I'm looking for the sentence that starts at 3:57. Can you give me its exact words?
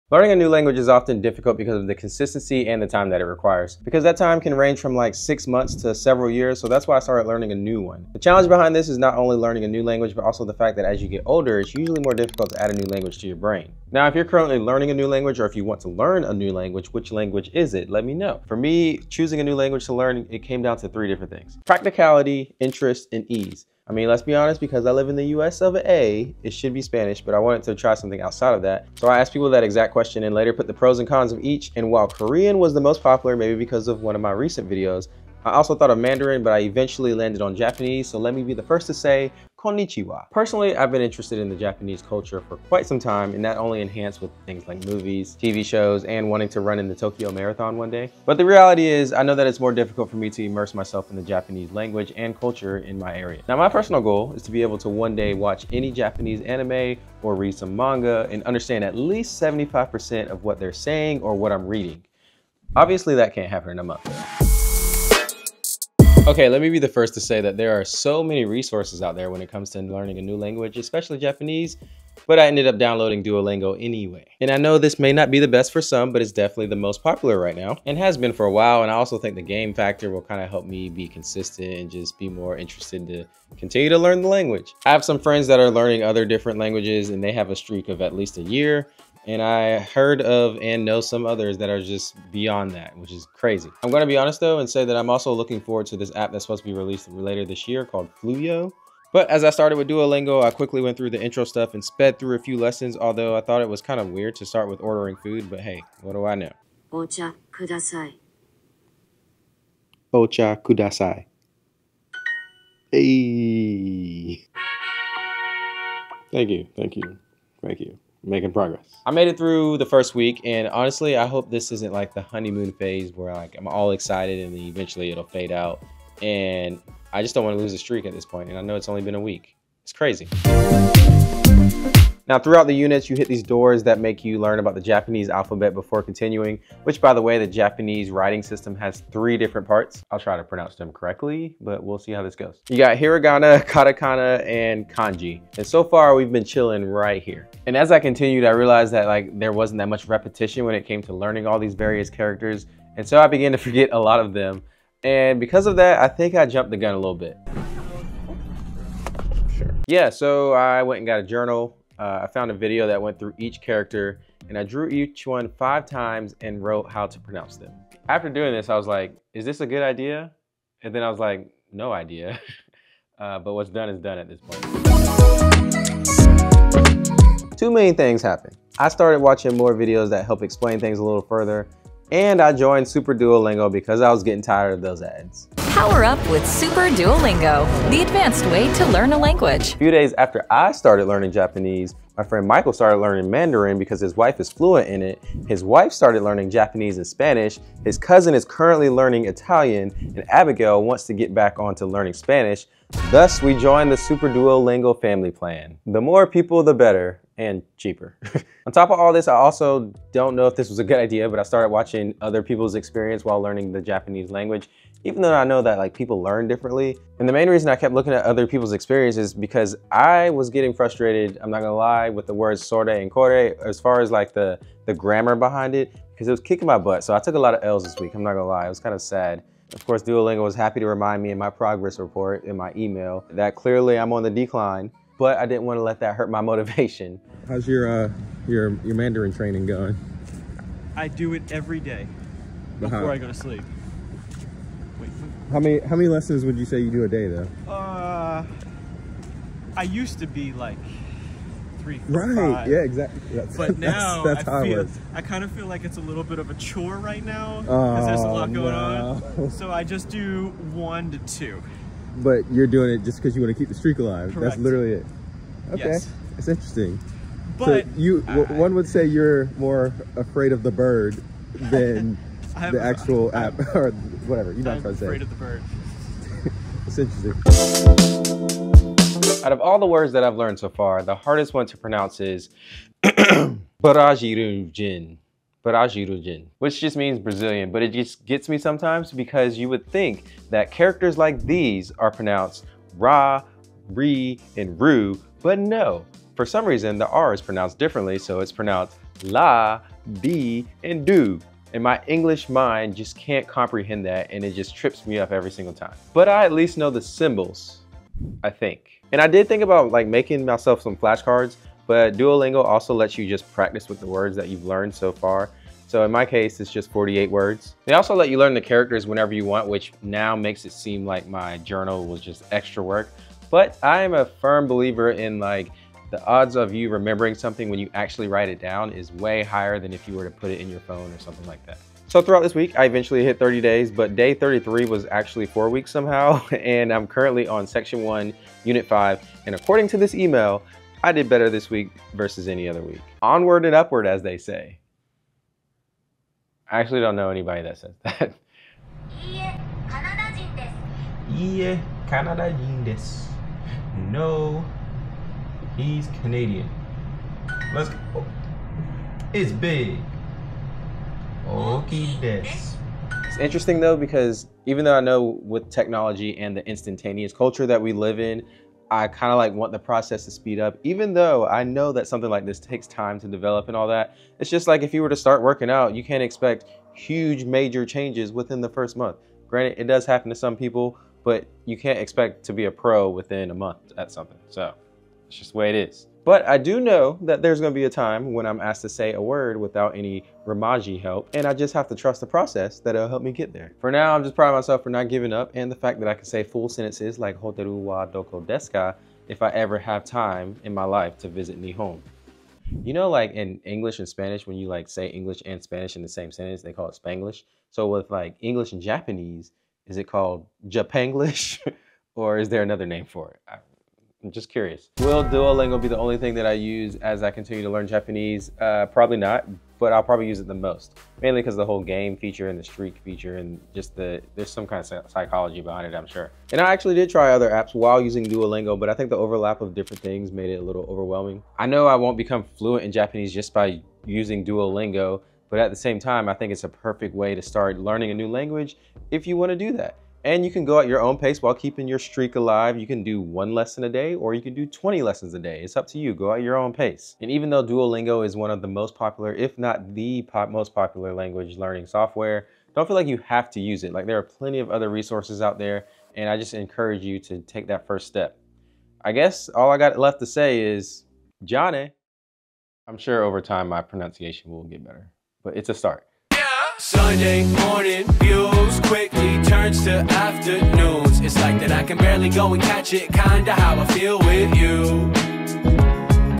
How's your, uh, your, your Mandarin training going?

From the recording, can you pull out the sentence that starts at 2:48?
After doing this, I was like, is this a good idea?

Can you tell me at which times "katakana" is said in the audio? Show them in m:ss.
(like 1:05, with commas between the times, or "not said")
2:23.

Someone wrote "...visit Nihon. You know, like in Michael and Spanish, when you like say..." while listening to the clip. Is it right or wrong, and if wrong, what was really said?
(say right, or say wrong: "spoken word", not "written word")
wrong: "English", not "Michael".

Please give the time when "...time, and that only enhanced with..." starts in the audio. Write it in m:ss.
0:42.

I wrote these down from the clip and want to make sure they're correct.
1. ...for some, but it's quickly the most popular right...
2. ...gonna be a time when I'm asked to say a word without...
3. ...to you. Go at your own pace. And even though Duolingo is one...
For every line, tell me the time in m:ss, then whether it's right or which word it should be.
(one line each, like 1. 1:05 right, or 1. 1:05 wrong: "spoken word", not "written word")
1. 1:15 wrong: "definitely", not "quickly"
2. 6:27 right
3. 7:25 right.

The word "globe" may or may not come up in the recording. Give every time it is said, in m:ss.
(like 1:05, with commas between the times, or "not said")
not said.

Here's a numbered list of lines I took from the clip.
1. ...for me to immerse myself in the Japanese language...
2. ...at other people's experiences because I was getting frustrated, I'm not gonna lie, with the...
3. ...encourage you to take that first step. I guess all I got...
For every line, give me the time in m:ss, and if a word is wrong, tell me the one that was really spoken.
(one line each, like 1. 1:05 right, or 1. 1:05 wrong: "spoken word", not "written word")
1. 0:50 right
2. 3:38 right
3. 7:36 right.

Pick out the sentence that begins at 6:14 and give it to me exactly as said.
It's just like if you were to start working out, you can't expect huge major changes within the first month.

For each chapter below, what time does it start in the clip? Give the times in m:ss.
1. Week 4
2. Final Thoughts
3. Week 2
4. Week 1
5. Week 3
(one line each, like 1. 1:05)
1. 4:38
2. 6:05
3. 2:10
4. 1:04
5. 2:55.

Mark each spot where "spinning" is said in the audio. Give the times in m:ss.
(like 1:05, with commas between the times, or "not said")
not said.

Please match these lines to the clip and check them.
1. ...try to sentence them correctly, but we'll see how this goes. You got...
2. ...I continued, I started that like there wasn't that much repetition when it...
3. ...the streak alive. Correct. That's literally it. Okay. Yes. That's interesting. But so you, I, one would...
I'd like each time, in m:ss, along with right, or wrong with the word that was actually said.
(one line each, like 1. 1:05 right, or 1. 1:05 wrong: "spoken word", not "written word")
1. 2:20 wrong: "pronounce", not "sentence"
2. 2:27 wrong: "realized", not "started"
3. 4:23 right.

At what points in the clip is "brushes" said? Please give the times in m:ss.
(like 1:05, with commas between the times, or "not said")
not said.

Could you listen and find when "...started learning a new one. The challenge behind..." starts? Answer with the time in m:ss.
0:06.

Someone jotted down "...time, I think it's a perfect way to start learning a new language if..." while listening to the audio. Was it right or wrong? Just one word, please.
right.